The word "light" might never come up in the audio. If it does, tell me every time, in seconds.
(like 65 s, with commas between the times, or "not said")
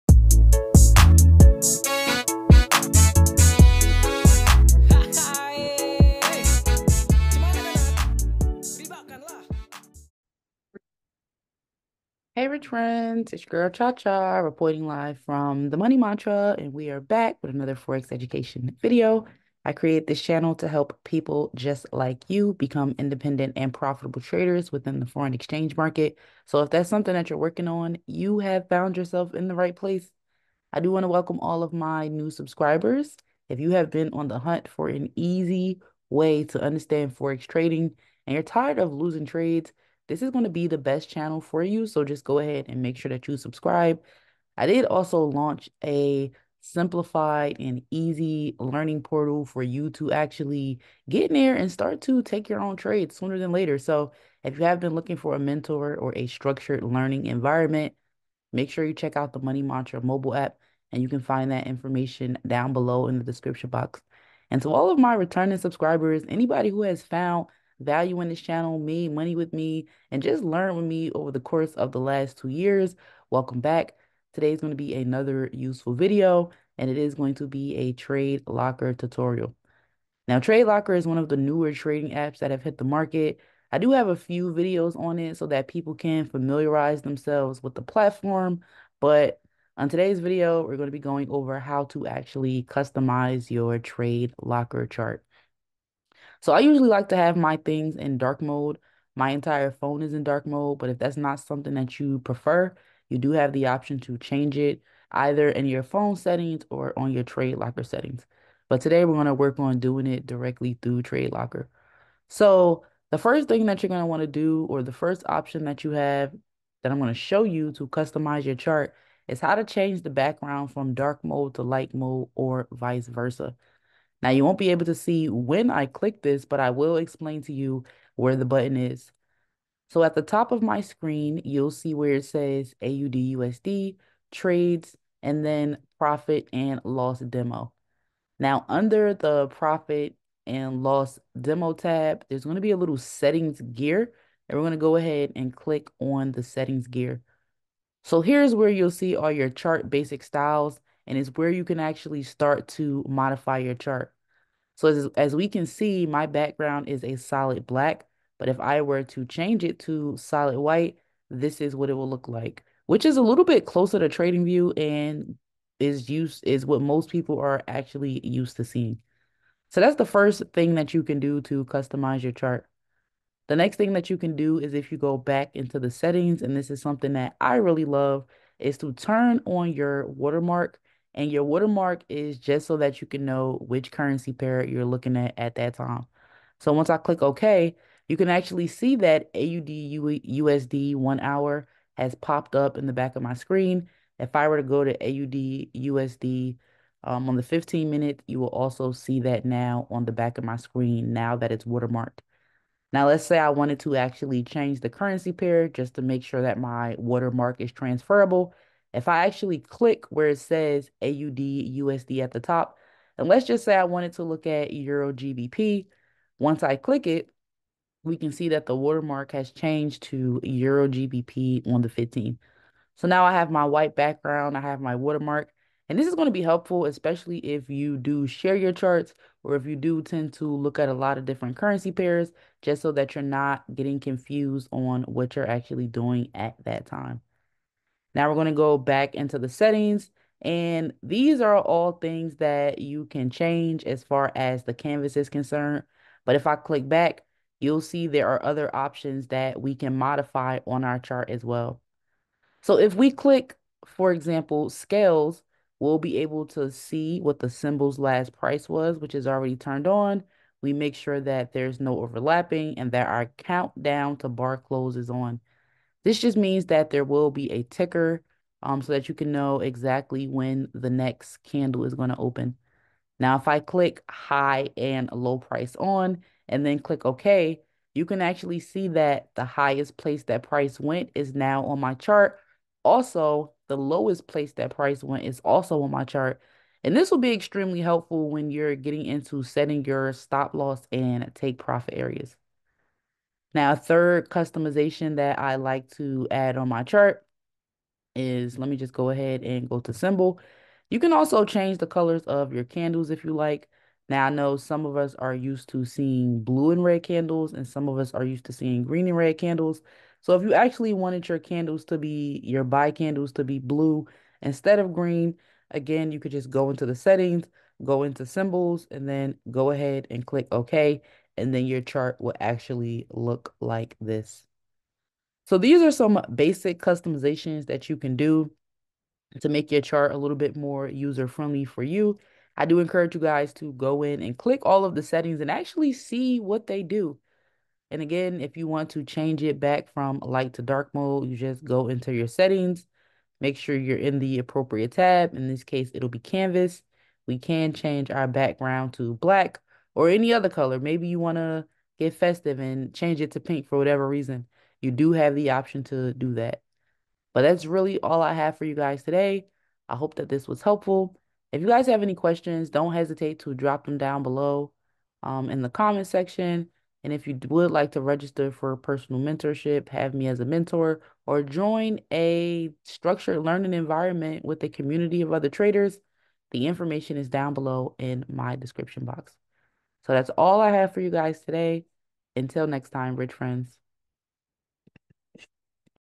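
121 s, 340 s.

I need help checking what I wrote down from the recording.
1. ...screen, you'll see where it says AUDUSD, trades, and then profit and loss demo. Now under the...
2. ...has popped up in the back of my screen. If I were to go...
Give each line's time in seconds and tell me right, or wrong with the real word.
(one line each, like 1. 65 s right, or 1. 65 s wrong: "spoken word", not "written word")
1. 130 s right
2. 191 s right.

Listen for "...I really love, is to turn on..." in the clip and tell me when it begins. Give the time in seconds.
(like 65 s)
177 s.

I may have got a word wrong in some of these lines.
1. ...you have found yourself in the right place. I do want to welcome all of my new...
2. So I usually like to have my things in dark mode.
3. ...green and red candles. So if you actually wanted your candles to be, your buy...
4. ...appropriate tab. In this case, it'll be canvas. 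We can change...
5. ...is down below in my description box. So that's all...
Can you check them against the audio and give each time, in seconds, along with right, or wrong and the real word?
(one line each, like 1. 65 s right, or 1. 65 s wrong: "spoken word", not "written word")
1. 28 s right
2. 96 s right
3. 308 s right
4. 344 s right
5. 377 s right.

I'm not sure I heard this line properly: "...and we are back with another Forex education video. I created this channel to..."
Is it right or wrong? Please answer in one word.
right.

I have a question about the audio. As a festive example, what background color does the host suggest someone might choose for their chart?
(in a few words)
pink.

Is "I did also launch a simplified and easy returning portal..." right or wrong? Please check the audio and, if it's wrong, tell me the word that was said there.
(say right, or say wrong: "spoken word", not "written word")
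wrong: "learning", not "returning".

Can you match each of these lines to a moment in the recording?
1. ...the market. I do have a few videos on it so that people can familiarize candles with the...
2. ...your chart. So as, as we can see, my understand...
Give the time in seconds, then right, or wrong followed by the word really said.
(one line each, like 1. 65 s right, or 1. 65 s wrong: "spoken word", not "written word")
1. 82 s wrong: "themselves", not "candles"
2. 153 s wrong: "background", not "understand".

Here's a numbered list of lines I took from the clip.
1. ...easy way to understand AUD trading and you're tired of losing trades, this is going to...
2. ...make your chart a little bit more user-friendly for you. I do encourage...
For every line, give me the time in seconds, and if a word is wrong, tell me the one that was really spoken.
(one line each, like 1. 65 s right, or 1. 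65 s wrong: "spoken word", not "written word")
1. 35 s wrong: "Forex", not "AUD"
2. 329 s right.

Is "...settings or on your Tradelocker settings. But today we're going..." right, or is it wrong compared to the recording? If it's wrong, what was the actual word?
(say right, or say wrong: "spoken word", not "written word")
right.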